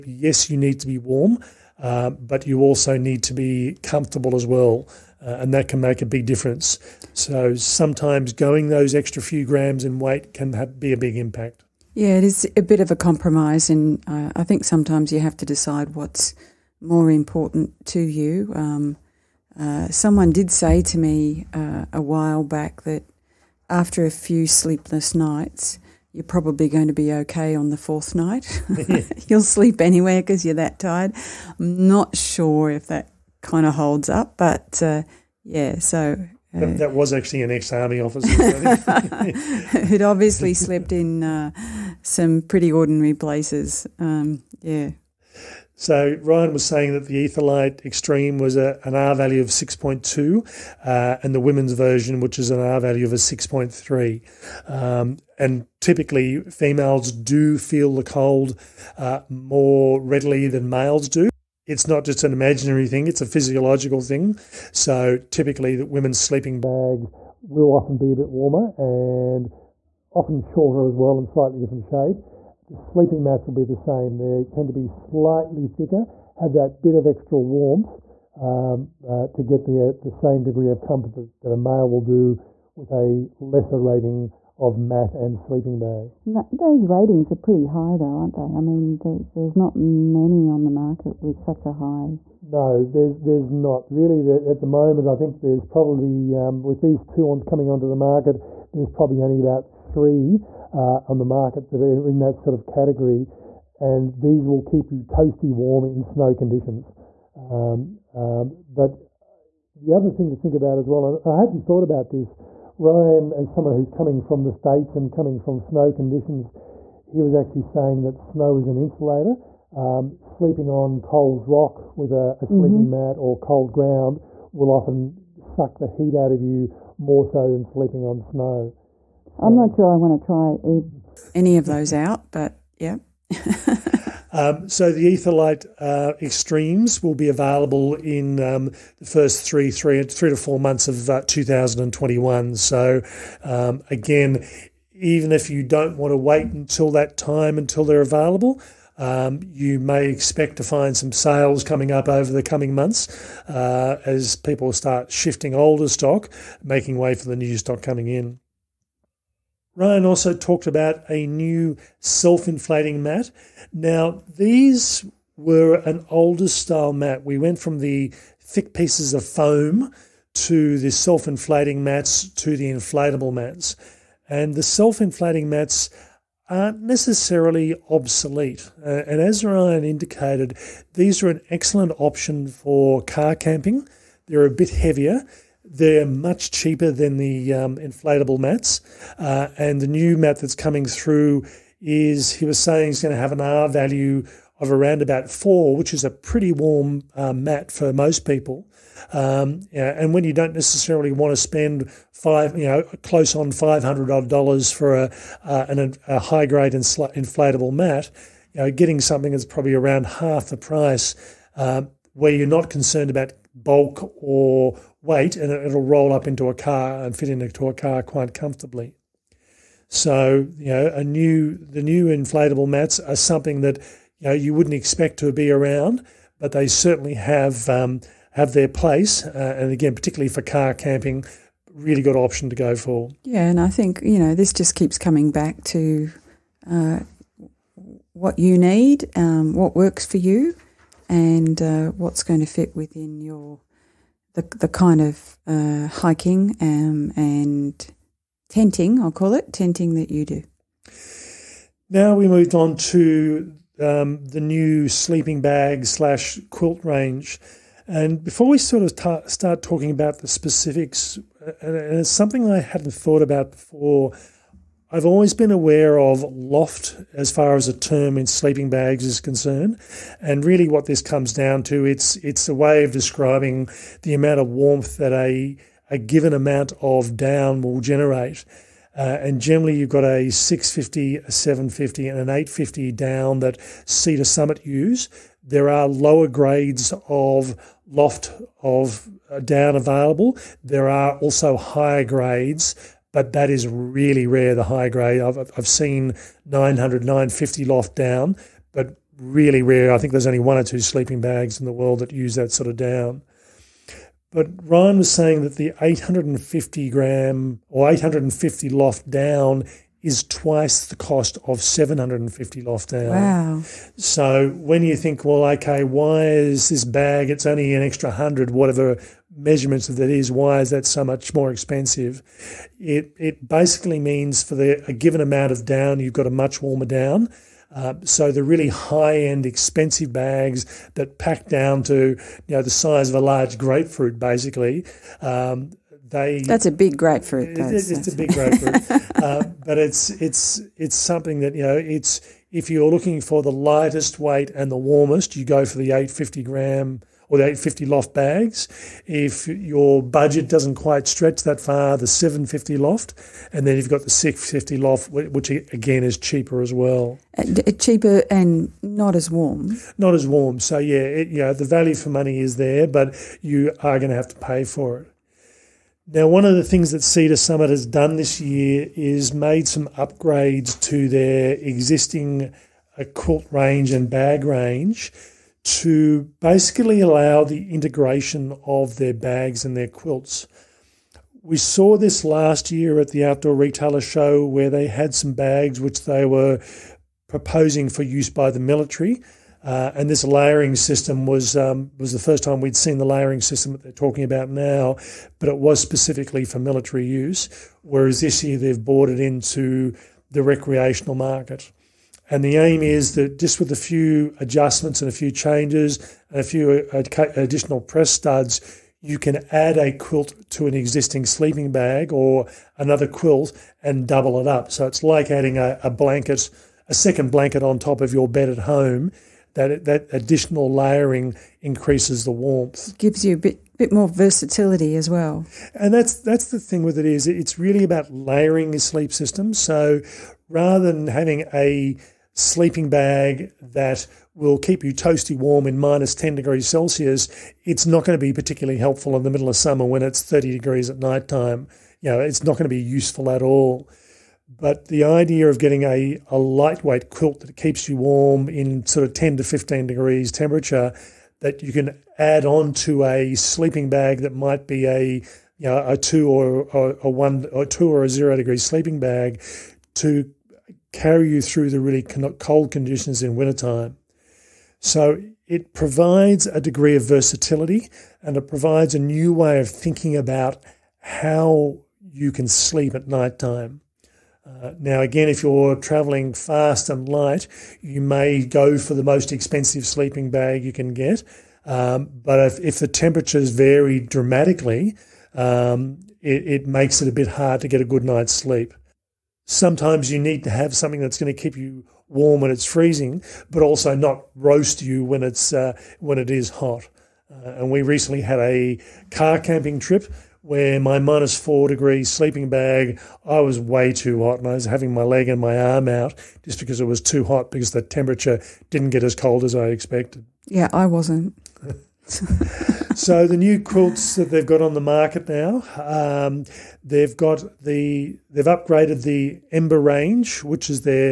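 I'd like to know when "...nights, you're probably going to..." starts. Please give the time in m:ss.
0:25.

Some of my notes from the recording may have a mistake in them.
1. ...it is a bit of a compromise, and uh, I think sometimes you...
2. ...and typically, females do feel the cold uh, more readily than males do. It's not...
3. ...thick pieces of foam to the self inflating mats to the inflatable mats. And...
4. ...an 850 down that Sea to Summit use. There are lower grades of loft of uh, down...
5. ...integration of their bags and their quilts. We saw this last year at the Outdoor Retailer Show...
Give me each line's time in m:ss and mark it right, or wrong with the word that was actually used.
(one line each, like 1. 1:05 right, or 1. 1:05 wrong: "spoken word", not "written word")
1. 0:12 right
2. 0:55 right
3. 2:48 right
4. 4:42 right
5. 6:17 right.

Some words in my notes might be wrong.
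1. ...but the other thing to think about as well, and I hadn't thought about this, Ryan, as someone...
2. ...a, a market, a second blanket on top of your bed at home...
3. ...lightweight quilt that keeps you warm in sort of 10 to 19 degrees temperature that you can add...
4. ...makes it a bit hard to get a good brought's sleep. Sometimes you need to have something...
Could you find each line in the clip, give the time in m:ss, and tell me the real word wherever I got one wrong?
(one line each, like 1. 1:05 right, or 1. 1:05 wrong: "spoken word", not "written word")
1. 1:48 right
2. 6:55 wrong: "blanket", not "market"
3. 7:26 wrong: "15", not "19"
4. 8:06 wrong: "night", not "brought".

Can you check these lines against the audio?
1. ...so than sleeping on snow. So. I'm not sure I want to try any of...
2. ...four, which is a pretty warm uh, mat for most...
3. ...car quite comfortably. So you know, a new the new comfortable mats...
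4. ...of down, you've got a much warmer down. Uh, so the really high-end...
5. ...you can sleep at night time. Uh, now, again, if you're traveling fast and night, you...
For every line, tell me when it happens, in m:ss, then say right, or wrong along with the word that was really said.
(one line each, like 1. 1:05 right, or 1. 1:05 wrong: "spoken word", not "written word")
1. 2:07 right
2. 3:15 right
3. 3:37 wrong: "inflatable", not "comfortable"
4. 5:25 right
5. 7:52 wrong: "light", not "night".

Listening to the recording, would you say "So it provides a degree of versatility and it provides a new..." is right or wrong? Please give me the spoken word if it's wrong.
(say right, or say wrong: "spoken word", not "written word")
right.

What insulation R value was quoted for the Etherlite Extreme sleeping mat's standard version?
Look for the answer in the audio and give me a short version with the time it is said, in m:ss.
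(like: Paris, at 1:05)
6.2, at 0:49.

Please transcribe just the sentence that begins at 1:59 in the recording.
Um, sleeping on cold rock with a, a sleeping mm -hmm.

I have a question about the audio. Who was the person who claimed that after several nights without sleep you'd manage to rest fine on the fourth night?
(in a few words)
An ex army officer.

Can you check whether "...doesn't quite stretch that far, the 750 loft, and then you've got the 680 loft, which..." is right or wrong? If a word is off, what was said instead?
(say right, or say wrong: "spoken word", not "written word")
wrong: "650", not "680".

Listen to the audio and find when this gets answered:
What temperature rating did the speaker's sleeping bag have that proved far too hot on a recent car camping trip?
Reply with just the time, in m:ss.
8:20.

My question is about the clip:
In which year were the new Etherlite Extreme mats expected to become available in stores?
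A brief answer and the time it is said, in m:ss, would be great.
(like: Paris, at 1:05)
2021, at 2:21.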